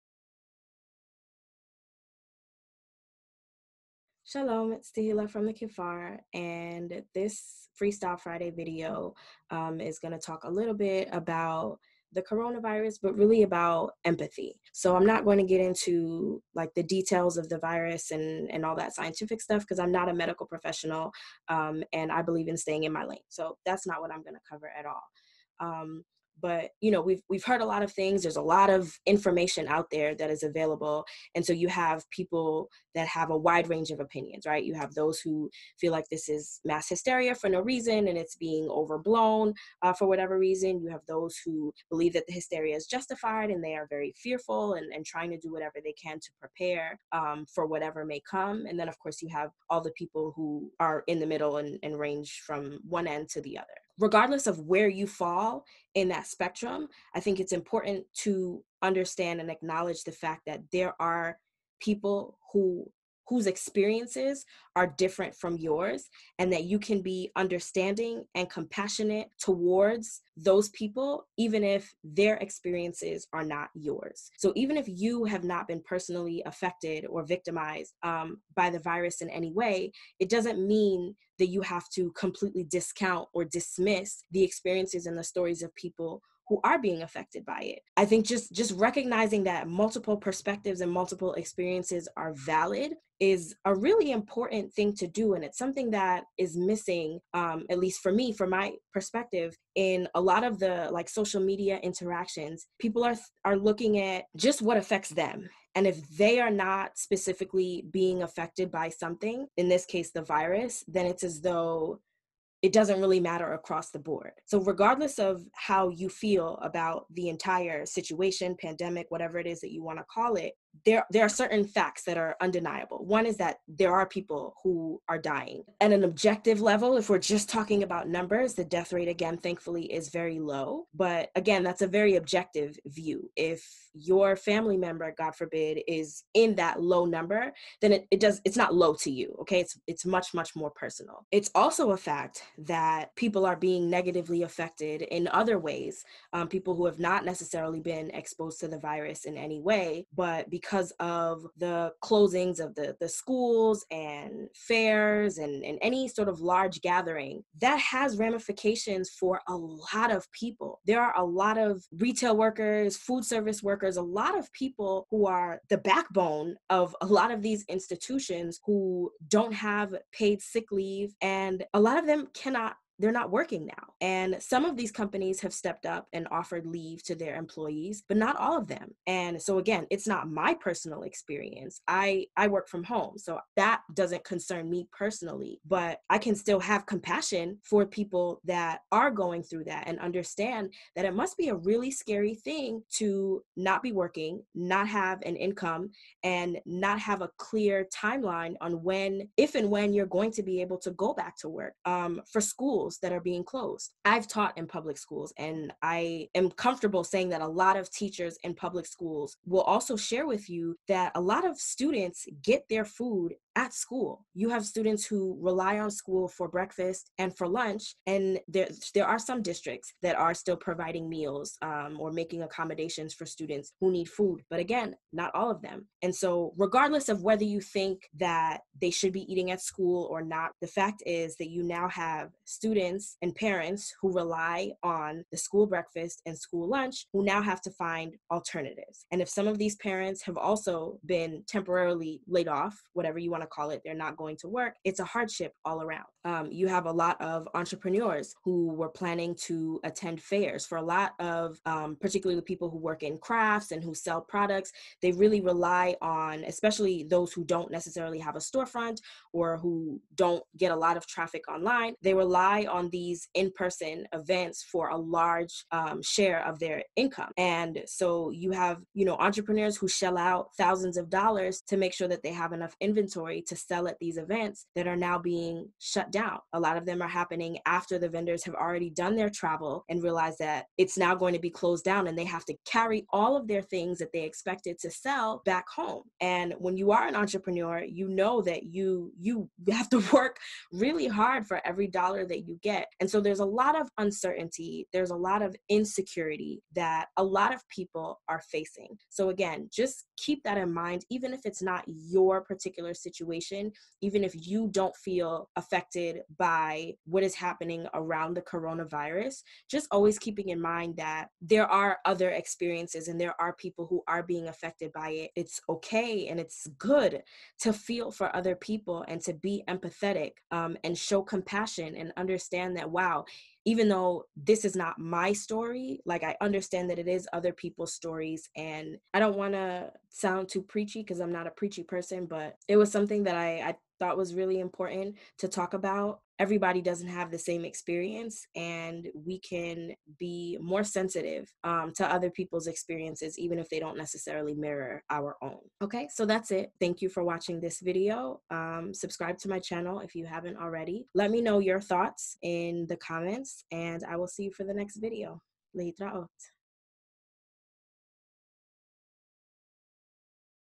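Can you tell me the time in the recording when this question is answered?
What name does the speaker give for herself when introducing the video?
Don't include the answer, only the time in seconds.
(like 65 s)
4 s.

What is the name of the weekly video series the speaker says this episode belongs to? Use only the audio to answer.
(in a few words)
Freestyle Friday.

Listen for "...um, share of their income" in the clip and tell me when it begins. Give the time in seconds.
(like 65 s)
265 s.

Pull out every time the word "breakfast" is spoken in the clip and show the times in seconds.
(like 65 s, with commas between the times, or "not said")
216 s, 235 s.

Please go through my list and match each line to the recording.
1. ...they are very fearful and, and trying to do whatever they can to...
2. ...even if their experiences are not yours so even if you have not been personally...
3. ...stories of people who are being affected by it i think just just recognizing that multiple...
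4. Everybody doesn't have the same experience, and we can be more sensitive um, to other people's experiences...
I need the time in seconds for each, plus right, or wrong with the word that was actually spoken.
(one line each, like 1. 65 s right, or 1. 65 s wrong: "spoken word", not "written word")
1. 43 s right
2. 71 s right
3. 85 s right
4. 336 s right.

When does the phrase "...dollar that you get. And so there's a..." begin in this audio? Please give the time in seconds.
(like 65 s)
291 s.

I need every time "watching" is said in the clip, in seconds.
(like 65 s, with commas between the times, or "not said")
347 s.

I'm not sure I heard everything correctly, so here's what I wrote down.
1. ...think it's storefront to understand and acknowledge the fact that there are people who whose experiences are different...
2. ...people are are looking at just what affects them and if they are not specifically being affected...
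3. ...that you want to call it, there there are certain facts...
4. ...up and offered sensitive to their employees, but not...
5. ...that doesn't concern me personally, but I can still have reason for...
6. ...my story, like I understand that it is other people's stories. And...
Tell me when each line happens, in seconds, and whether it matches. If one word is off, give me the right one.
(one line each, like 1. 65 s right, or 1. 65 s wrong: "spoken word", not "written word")
1. 57 s wrong: "important", not "storefront"
2. 102 s right
3. 119 s right
4. 175 s wrong: "leave", not "sensitive"
5. 183 s wrong: "compassion", not "reason"
6. 324 s right.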